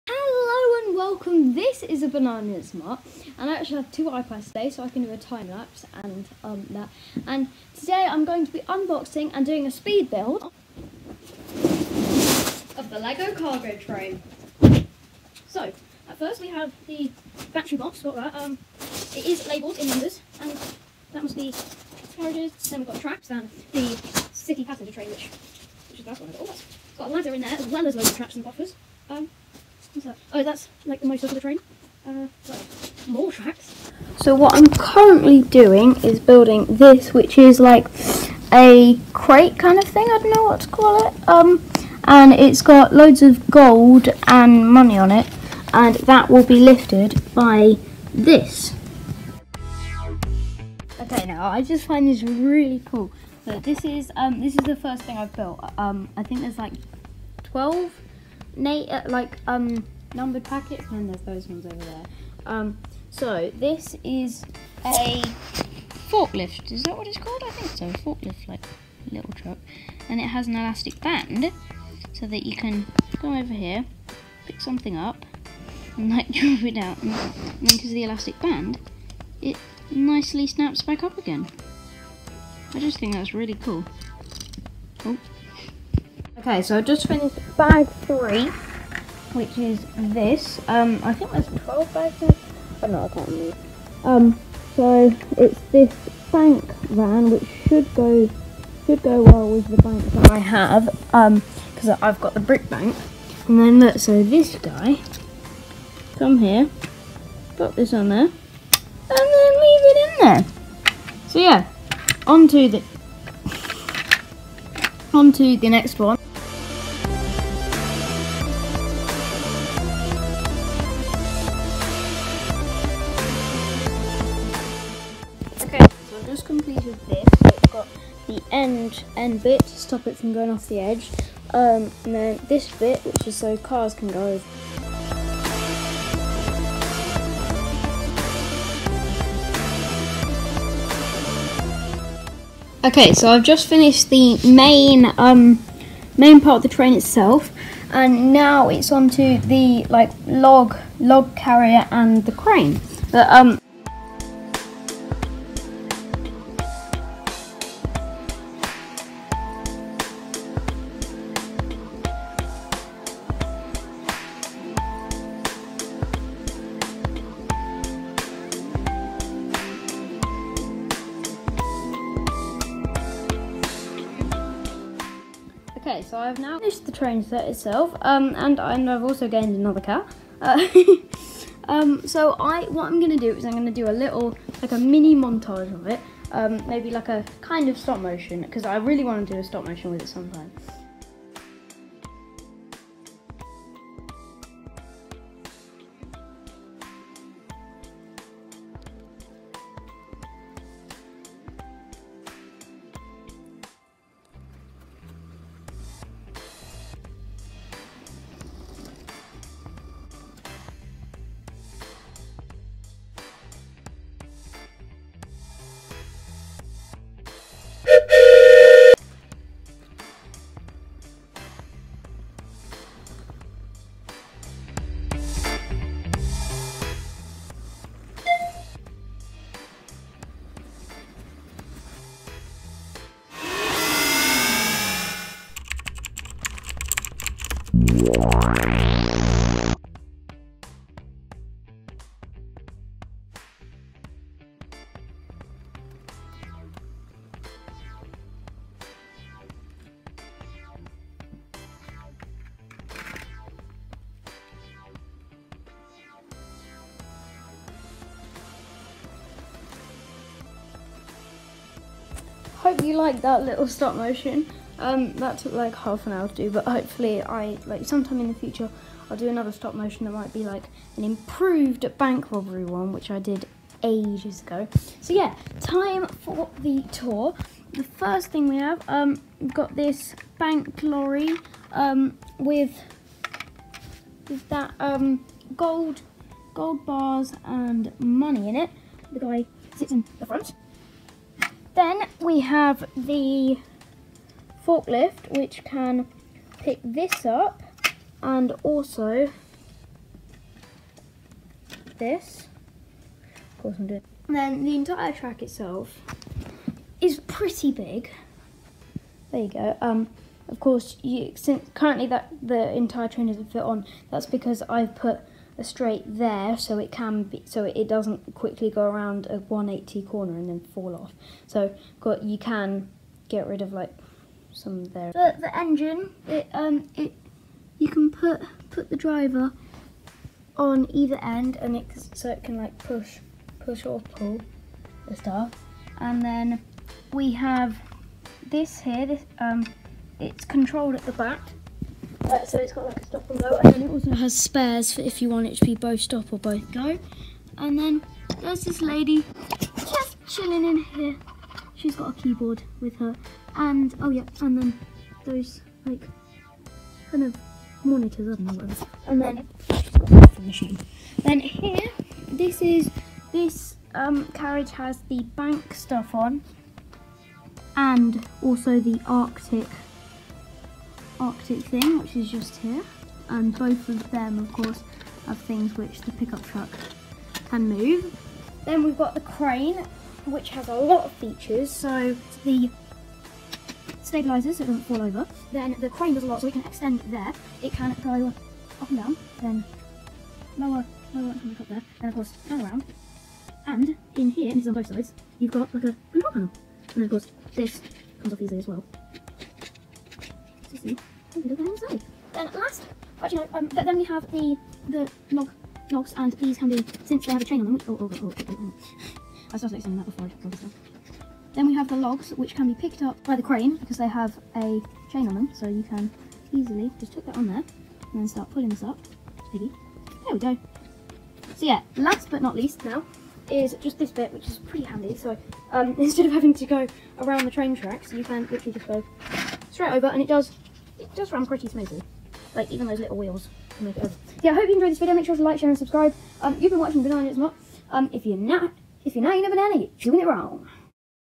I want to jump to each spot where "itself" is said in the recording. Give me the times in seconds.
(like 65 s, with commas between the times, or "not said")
146 s, 177 s, 305 s.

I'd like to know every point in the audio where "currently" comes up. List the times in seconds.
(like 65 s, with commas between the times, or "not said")
34 s, 311 s.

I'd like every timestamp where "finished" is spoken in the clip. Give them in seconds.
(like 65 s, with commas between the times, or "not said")
87 s, 143 s, 176 s.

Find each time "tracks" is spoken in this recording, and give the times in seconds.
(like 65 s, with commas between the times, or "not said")
23 s, 33 s, 305 s, 427 s.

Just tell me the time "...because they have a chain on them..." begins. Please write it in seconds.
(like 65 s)
413 s.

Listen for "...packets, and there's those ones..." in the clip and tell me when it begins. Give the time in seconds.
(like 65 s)
60 s.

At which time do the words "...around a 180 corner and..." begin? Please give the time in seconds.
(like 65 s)
318 s.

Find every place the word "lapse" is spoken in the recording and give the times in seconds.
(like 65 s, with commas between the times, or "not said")
5 s.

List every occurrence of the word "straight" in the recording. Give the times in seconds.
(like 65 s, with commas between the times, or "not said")
315 s, 429 s.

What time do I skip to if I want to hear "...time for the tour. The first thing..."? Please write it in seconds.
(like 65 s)
275 s.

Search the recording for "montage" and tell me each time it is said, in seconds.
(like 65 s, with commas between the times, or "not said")
185 s.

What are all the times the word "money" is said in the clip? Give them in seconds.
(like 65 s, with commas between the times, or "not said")
44 s, 287 s.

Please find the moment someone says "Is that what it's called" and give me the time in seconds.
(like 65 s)
66 s.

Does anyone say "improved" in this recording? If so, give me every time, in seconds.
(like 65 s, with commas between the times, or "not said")
271 s.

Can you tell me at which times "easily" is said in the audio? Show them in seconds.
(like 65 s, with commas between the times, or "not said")
398 s, 416 s.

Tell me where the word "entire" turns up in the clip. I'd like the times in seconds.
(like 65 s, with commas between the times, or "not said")
304 s, 312 s.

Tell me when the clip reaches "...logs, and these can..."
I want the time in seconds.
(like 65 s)
405 s.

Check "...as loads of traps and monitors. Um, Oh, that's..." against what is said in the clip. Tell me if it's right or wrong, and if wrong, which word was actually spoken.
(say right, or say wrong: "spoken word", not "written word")
wrong: "buffers", not "monitors".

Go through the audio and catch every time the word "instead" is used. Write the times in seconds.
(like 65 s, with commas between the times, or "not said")
425 s.